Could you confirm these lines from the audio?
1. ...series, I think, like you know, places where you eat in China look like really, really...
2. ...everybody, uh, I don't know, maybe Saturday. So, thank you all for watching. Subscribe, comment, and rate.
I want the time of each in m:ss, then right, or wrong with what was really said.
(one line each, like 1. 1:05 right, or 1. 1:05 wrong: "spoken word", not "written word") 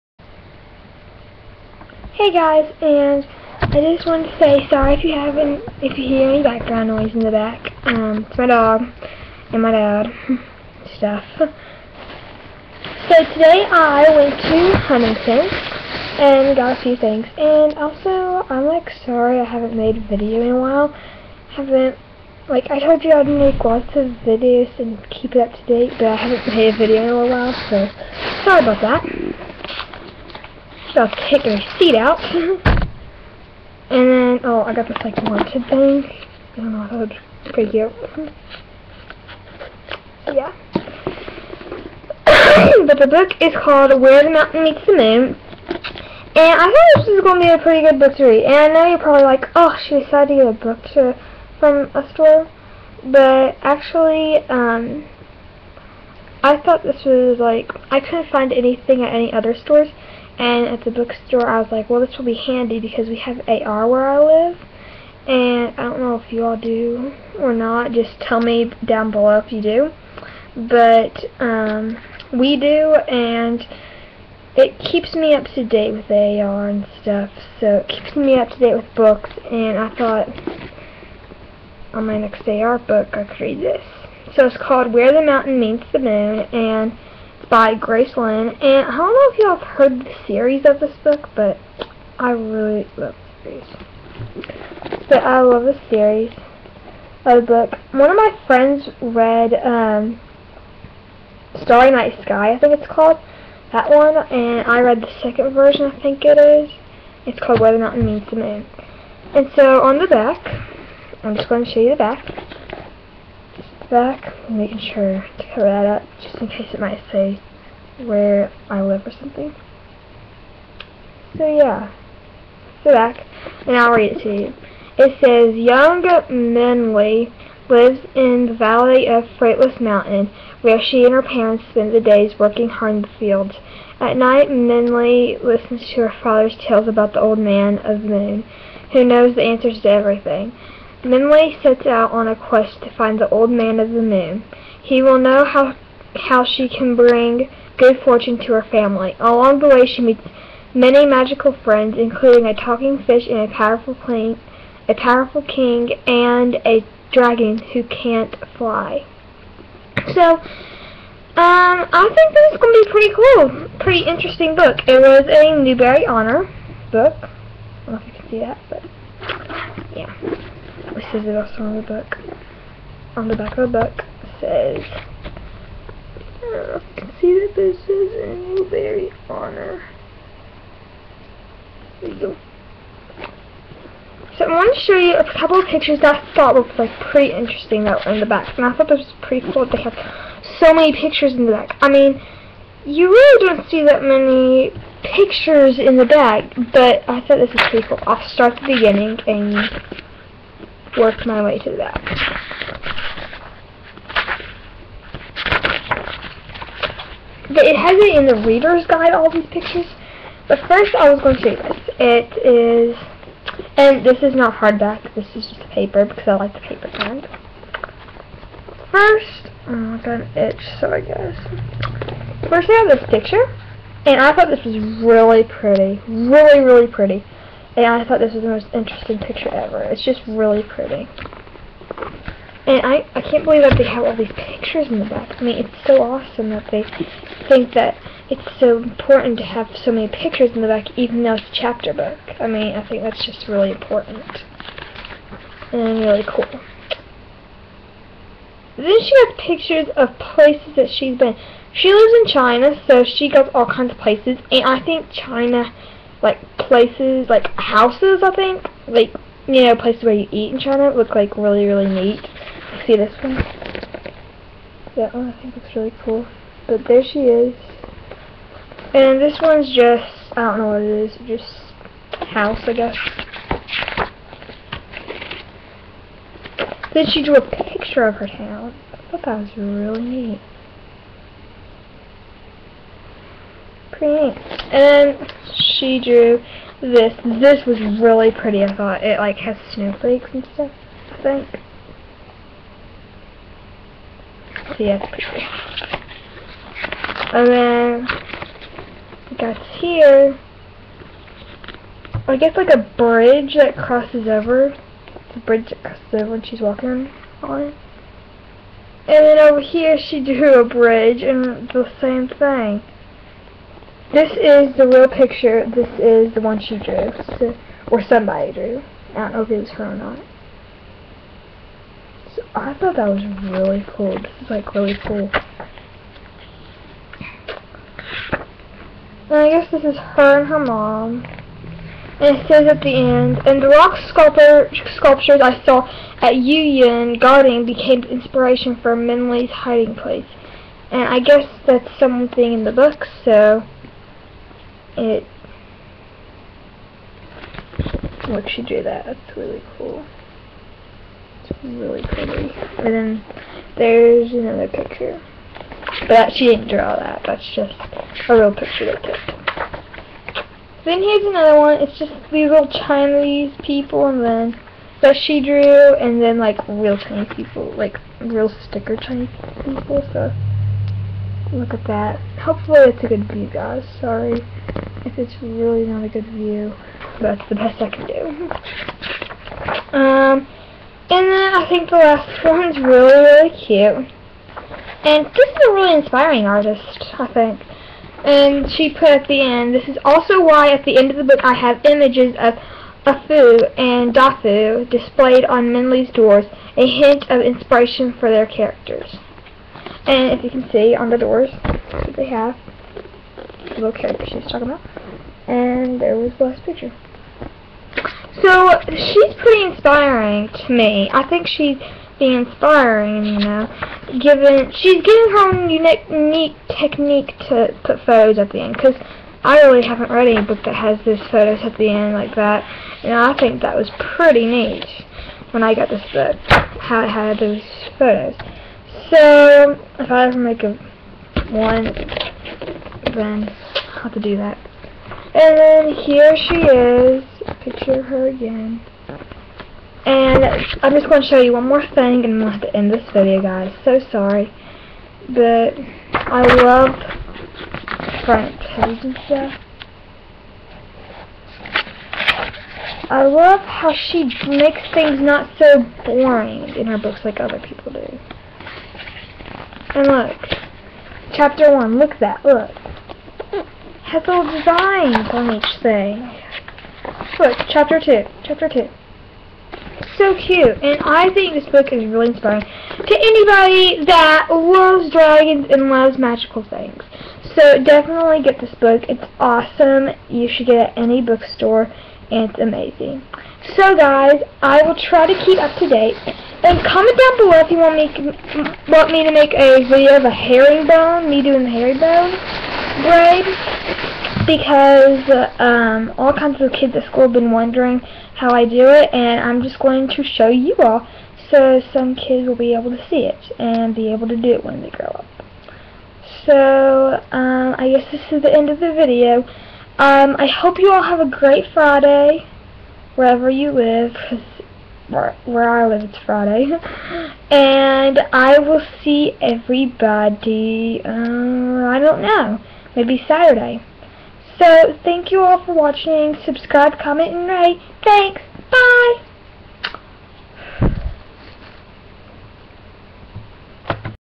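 1. 4:17 wrong: "houses", not "series"
2. 8:39 right.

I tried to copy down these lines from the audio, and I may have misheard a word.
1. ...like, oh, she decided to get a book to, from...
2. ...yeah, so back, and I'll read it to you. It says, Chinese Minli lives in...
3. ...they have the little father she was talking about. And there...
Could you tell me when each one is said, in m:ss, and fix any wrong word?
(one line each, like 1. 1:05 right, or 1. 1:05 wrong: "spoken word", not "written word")
1. 0:49 right
2. 2:01 wrong: "Young", not "Chinese"
3. 6:42 wrong: "character", not "father".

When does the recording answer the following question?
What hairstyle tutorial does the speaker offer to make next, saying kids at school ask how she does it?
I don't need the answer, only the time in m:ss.
8:11.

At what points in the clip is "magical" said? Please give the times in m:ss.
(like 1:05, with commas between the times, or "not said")
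2:31, 7:56.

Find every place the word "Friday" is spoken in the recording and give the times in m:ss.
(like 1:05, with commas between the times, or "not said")
8:31, 8:36.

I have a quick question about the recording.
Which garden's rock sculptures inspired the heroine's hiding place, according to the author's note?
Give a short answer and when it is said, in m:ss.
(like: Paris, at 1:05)
Yuyuan Garden, at 5:36.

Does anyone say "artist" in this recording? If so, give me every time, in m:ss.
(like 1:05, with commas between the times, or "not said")
6:26.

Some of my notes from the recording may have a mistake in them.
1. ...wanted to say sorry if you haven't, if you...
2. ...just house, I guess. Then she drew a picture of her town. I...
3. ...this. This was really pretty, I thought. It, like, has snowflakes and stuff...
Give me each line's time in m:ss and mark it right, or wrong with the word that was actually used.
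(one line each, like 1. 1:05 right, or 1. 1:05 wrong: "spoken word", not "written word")
1. 0:04 right
2. 4:31 right
3. 4:46 right.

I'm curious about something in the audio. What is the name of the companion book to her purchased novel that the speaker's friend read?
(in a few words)
Starry Night Sky.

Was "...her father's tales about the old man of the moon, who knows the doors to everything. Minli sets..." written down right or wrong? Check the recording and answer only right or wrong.
wrong.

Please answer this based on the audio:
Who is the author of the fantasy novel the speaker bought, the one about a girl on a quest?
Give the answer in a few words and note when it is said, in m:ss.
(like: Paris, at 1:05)
Grace Lin, at 1:27.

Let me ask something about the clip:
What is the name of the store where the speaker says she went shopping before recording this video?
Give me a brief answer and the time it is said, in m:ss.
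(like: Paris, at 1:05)
Huntington, at 0:14.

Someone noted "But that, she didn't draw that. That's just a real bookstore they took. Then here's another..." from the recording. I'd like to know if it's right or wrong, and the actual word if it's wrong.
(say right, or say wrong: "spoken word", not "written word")
wrong: "picture", not "bookstore".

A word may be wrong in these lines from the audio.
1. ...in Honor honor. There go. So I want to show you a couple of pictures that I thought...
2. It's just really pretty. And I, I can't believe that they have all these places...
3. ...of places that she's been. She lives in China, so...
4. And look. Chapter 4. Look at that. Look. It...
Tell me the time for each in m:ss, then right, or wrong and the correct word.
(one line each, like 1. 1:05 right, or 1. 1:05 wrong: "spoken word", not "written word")
1. 2:58 wrong: "Newbery", not "Honor"
2. 3:49 wrong: "pictures", not "places"
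3. 4:09 right
4. 7:39 wrong: "1", not "4".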